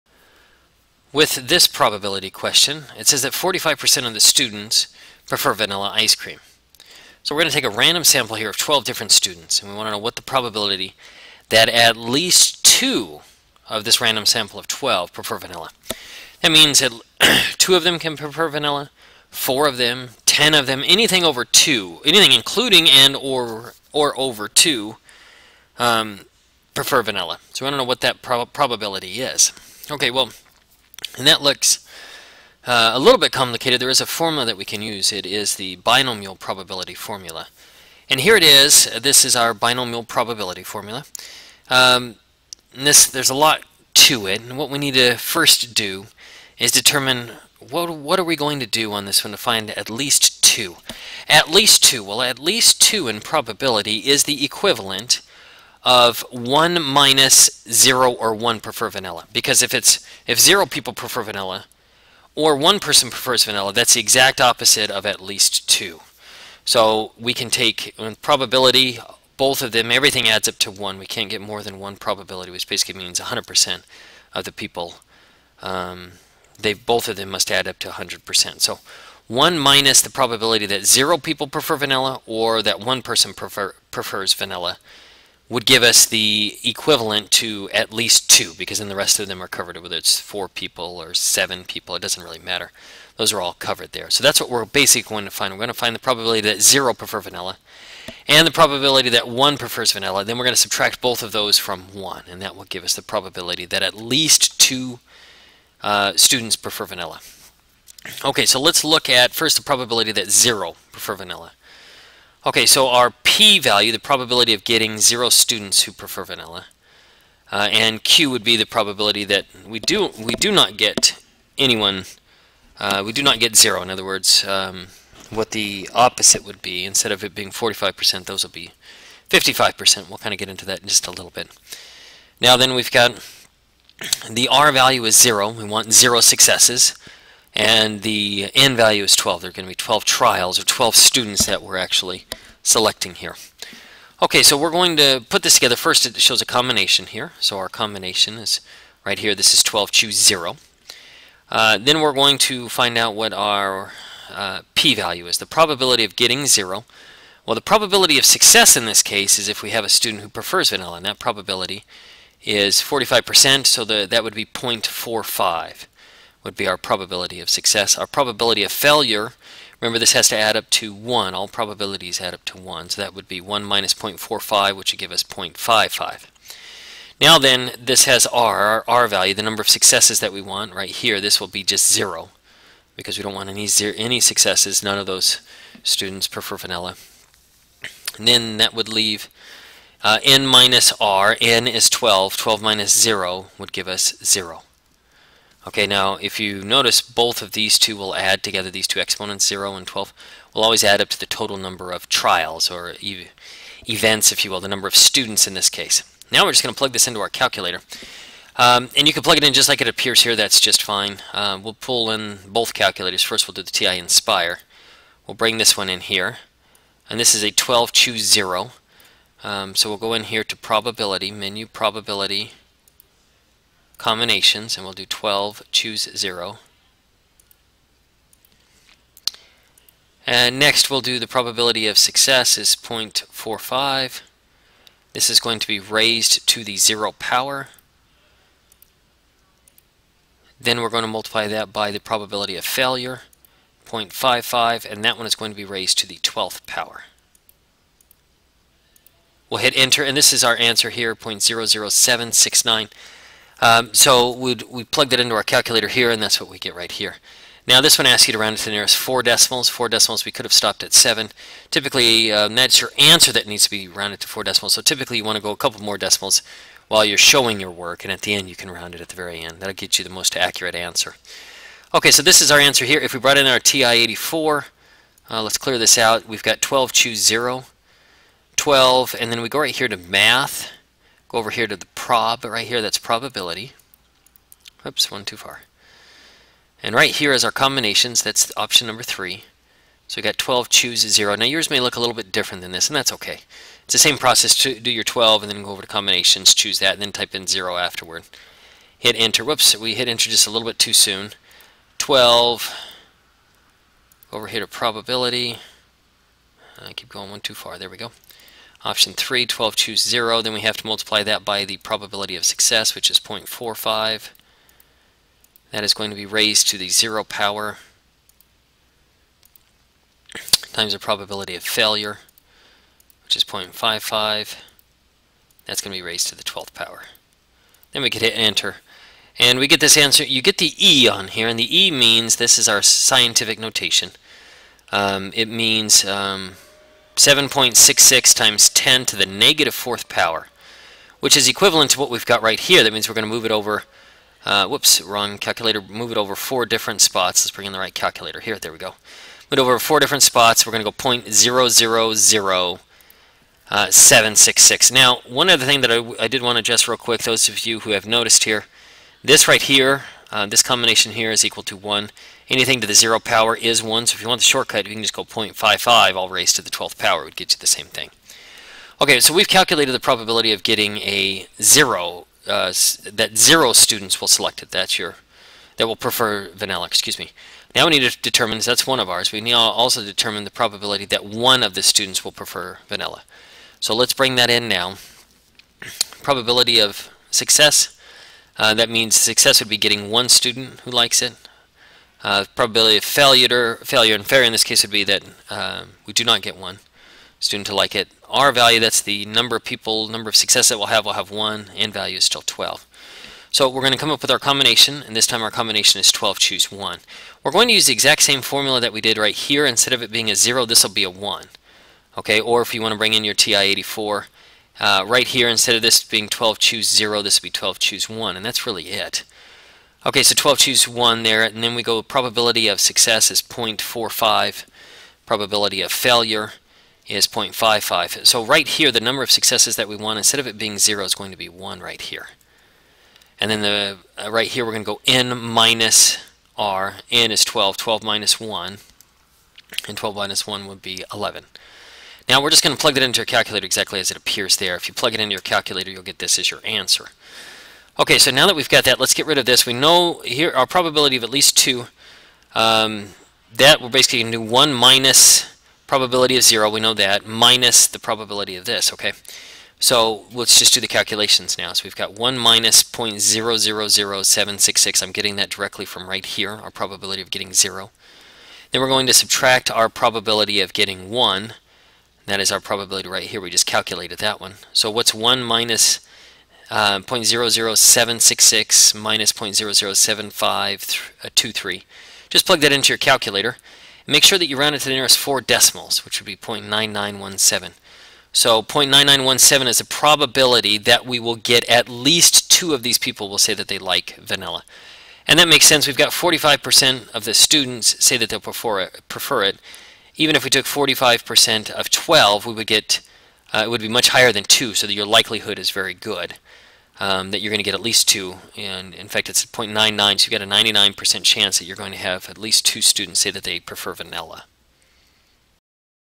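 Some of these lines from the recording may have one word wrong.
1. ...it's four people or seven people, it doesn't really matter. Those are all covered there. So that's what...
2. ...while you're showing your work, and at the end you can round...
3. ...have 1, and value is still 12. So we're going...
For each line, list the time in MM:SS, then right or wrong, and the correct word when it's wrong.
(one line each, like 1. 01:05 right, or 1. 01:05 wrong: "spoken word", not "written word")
1. 01:29 right
2. 04:26 right
3. 06:41 right.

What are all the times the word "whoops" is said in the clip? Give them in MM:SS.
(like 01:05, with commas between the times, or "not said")
04:59, 05:44.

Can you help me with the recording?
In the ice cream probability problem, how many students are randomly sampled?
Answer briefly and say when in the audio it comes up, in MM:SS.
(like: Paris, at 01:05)
12, at 00:08.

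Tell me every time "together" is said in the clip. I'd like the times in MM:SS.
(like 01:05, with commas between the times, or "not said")
02:25, 03:18.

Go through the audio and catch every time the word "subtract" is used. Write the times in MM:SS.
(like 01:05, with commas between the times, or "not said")
01:40, 07:49.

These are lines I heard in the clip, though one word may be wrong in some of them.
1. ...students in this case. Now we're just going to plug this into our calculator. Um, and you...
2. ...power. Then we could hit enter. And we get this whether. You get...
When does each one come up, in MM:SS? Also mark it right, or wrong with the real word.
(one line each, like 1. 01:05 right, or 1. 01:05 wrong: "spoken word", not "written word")
1. 03:24 right
2. 05:26 wrong: "answer", not "whether".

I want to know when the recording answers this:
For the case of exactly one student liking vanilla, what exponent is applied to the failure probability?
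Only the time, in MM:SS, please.
07:21.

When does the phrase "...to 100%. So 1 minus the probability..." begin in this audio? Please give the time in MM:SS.
01:17.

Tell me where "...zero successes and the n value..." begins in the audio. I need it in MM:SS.
02:15.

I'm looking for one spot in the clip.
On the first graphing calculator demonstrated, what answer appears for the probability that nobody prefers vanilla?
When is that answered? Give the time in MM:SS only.
04:11.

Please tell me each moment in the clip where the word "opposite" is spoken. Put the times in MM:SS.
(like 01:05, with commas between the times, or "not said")
01:04, 02:05.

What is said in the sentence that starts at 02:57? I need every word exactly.
Now then, this has r, our r value, the number of successes that we want right here.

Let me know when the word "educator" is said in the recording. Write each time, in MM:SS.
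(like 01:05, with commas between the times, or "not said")
not said.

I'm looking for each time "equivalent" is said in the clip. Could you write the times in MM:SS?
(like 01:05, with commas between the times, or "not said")
00:54, 01:26, 05:41.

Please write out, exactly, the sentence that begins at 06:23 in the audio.
So let's bring that in now.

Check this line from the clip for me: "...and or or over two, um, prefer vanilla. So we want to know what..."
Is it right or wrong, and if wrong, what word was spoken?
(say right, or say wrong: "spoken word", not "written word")
right.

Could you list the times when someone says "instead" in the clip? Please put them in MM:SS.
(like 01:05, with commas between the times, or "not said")
02:06, 06:49, 06:55, 07:10.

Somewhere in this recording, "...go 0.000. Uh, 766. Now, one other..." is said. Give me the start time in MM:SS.
05:50.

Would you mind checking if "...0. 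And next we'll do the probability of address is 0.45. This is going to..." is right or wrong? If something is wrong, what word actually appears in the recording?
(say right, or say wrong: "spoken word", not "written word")
wrong: "success", not "address".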